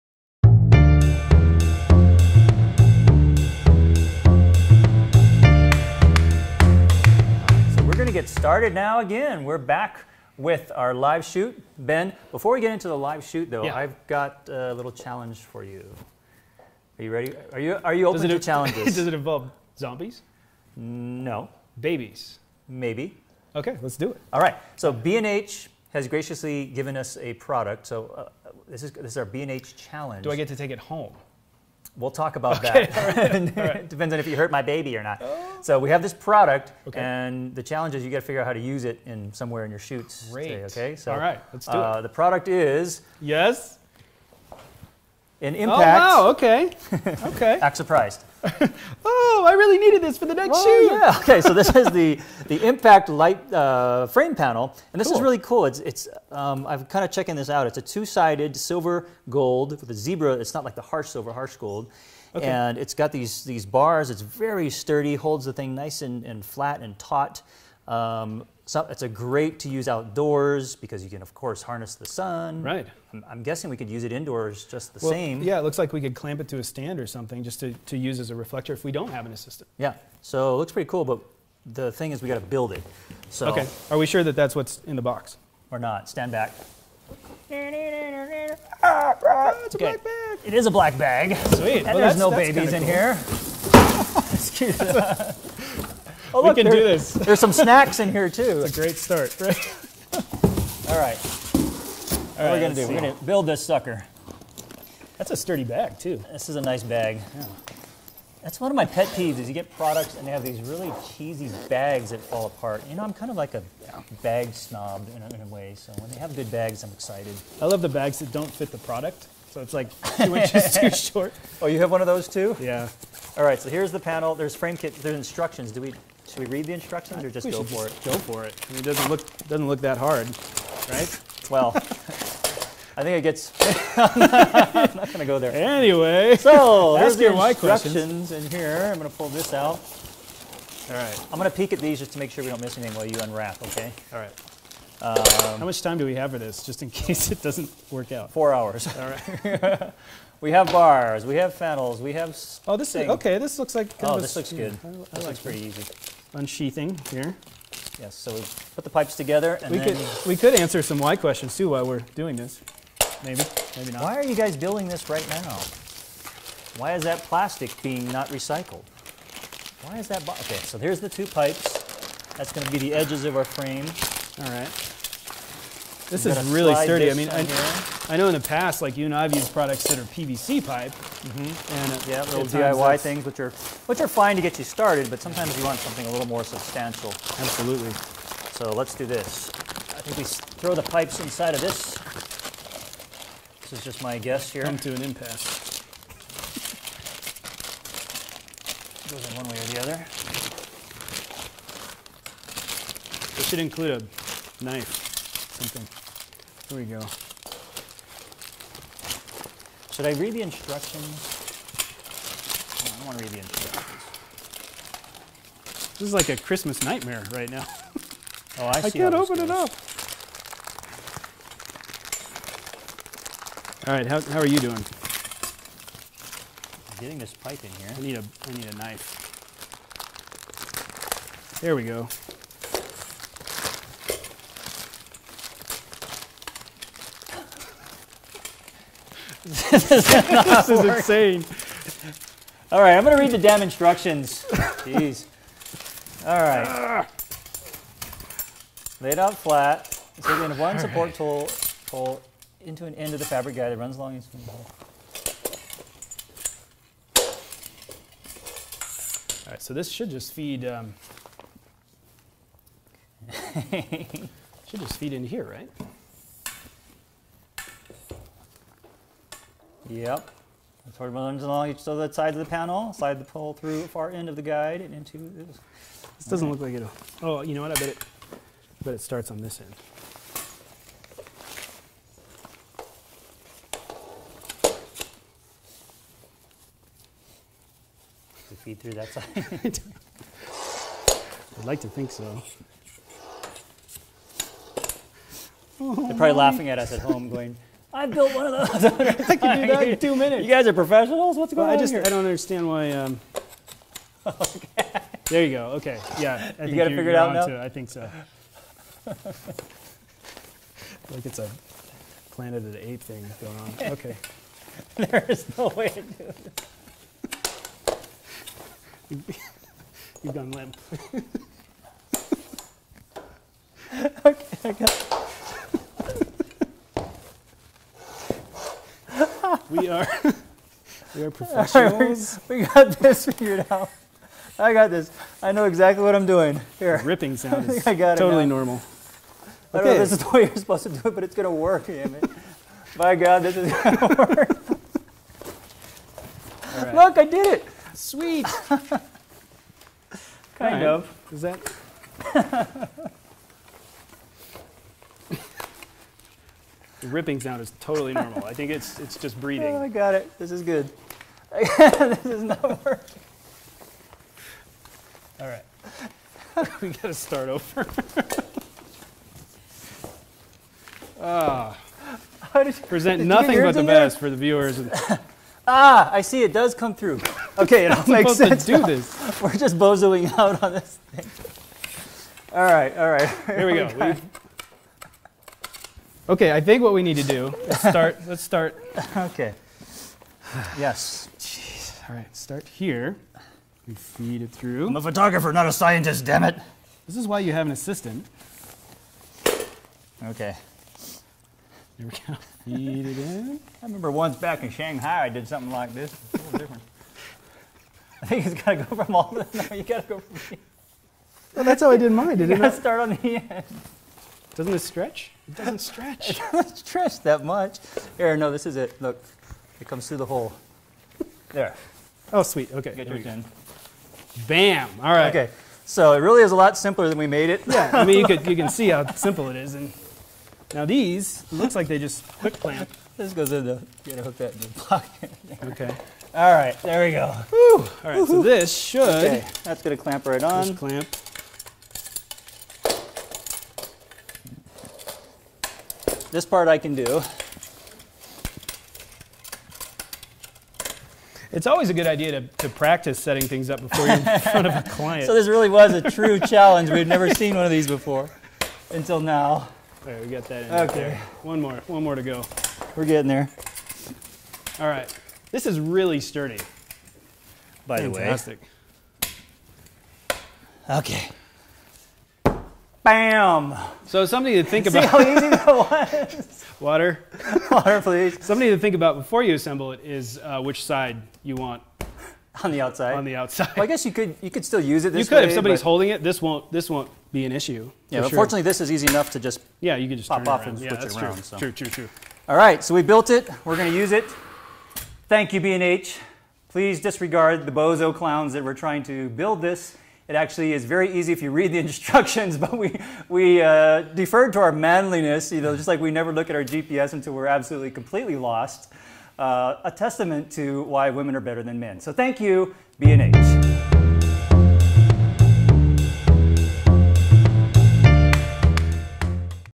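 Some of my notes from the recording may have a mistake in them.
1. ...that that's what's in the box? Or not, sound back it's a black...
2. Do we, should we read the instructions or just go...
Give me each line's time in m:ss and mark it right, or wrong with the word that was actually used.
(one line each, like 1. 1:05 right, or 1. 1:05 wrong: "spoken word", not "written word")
1. 1:24 wrong: "stand", not "sound"
2. 2:05 right.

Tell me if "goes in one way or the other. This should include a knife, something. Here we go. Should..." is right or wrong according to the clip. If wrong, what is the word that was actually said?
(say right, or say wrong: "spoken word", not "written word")
right.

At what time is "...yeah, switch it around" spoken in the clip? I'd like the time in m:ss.
8:10.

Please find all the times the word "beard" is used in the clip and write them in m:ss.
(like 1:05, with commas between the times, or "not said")
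not said.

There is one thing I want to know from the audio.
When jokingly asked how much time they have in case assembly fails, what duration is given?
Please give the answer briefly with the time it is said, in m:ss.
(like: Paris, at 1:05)
4 hours, at 2:28.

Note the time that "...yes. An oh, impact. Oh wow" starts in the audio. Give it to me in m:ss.
0:43.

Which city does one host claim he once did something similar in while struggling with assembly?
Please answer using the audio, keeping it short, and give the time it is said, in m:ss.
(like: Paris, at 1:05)
Shanghai, at 6:44.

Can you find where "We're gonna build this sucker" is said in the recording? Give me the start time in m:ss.
1:42.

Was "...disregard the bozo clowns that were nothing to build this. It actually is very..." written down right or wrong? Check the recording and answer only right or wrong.
wrong.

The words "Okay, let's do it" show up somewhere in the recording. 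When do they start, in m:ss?
0:23.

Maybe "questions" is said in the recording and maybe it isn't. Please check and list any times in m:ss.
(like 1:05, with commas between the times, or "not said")
2:17, 2:41.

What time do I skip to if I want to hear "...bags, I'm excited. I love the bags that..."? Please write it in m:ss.
1:56.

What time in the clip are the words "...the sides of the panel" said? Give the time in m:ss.
4:31.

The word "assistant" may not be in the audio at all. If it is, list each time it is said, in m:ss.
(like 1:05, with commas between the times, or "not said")
1:19, 6:37.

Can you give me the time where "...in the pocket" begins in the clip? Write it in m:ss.
7:14.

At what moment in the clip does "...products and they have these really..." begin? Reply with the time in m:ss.
1:49.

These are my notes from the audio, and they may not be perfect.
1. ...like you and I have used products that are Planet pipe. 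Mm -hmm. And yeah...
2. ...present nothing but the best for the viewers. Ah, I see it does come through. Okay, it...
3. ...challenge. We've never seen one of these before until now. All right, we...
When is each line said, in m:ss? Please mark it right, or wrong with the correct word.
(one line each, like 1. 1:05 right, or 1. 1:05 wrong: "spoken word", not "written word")
1. 2:58 wrong: "PVC", not "Planet"
2. 6:12 right
3. 7:36 right.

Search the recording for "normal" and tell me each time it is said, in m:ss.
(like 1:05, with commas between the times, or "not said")
5:38, 5:58.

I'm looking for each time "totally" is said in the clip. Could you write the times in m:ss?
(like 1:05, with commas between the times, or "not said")
5:38, 5:57.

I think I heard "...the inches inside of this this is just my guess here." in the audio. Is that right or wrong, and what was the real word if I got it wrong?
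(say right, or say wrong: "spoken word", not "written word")
wrong: "pipes", not "inches".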